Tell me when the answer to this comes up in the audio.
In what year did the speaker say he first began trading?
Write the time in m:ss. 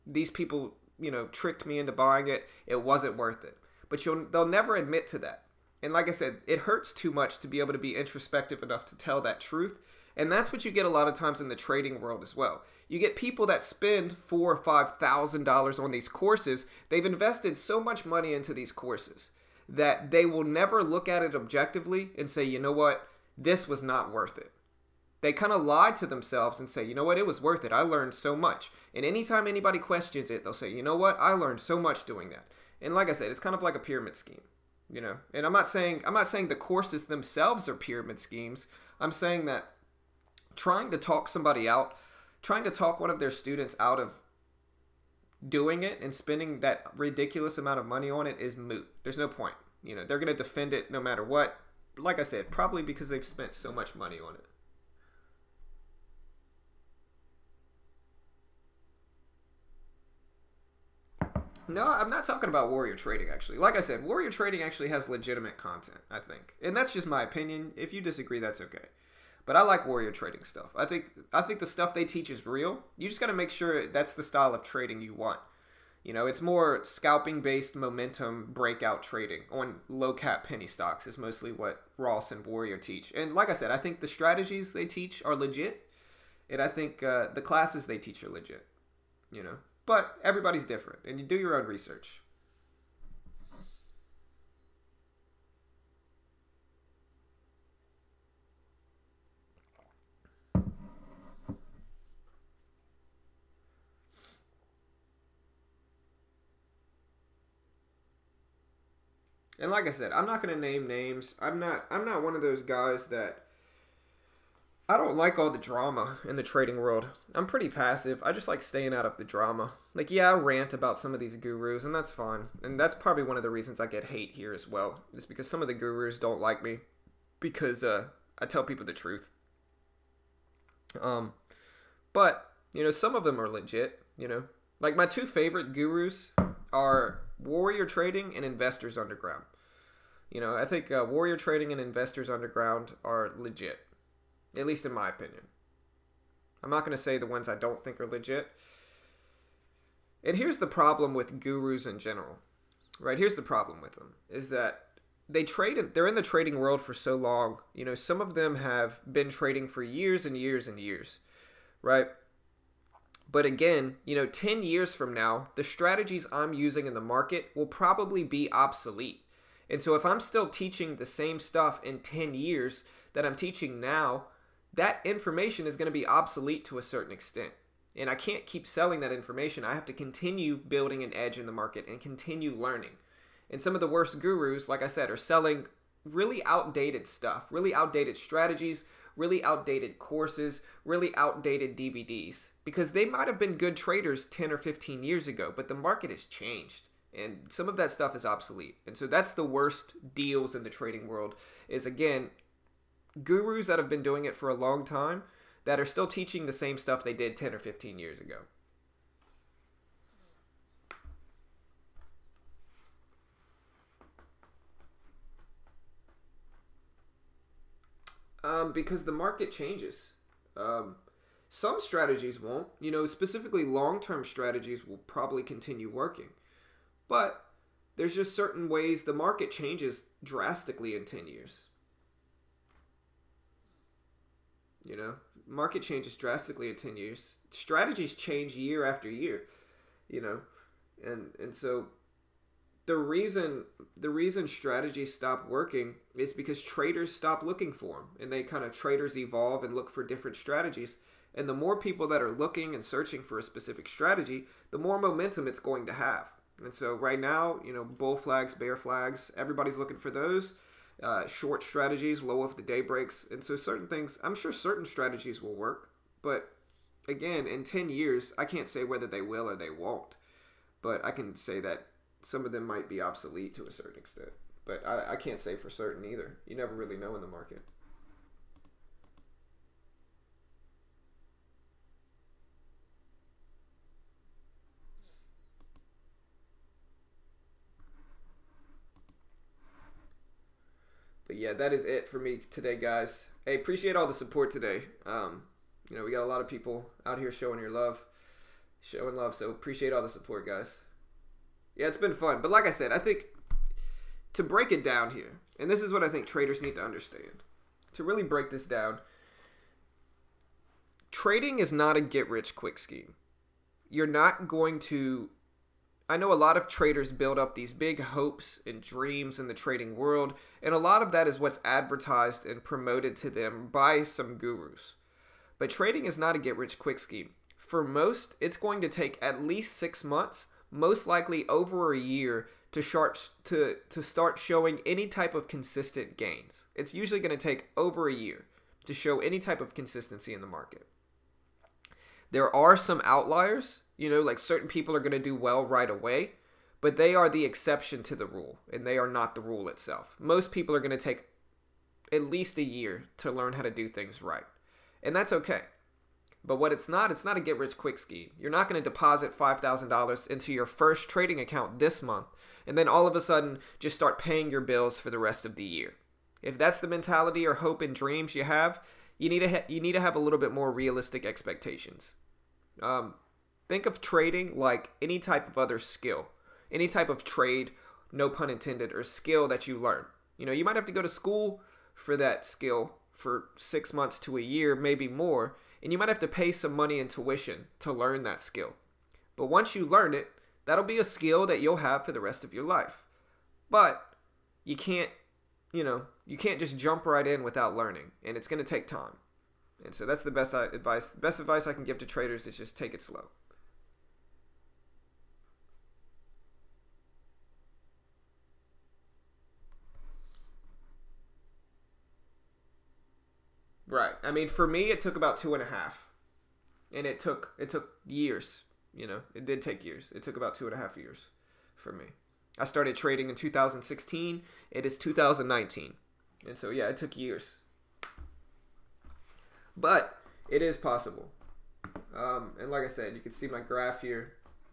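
7:03.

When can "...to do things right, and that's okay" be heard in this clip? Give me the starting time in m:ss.
5:53.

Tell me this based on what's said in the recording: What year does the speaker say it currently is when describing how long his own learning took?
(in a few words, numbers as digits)
2019.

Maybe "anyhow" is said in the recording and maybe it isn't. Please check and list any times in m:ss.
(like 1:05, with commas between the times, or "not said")
not said.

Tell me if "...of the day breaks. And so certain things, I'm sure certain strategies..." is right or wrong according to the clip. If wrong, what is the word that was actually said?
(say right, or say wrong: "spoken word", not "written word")
right.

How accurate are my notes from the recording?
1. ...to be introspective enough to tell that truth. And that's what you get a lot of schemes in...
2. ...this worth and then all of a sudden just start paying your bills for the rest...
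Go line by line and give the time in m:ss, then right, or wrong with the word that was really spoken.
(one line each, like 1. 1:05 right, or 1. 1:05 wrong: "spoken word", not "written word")
1. 0:07 wrong: "times", not "schemes"
2. 6:01 wrong: "month", not "worth".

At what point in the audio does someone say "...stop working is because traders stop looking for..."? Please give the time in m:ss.
4:05.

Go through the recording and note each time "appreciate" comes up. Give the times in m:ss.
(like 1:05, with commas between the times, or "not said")
4:53, 4:59.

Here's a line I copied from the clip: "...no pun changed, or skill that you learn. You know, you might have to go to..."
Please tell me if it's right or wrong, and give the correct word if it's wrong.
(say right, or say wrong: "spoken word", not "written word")
wrong: "intended", not "changed".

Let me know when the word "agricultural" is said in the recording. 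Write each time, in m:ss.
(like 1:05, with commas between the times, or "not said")
not said.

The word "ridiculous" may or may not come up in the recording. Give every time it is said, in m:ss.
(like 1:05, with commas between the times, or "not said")
0:46.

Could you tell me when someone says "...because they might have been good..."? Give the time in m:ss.
3:12.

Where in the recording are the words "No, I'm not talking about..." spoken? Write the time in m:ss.
1:01.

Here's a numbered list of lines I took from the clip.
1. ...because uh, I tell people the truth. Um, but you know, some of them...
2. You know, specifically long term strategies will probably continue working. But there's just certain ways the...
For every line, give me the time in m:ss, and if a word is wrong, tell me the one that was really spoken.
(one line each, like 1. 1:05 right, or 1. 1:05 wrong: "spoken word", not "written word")
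1. 2:07 right
2. 3:42 right.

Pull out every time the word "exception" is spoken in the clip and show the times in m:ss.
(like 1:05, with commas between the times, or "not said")
5:47.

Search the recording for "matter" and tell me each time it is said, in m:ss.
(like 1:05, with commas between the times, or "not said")
0:51.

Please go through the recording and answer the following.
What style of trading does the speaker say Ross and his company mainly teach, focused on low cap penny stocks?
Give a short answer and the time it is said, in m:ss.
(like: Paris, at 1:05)
Scalping, at 1:16.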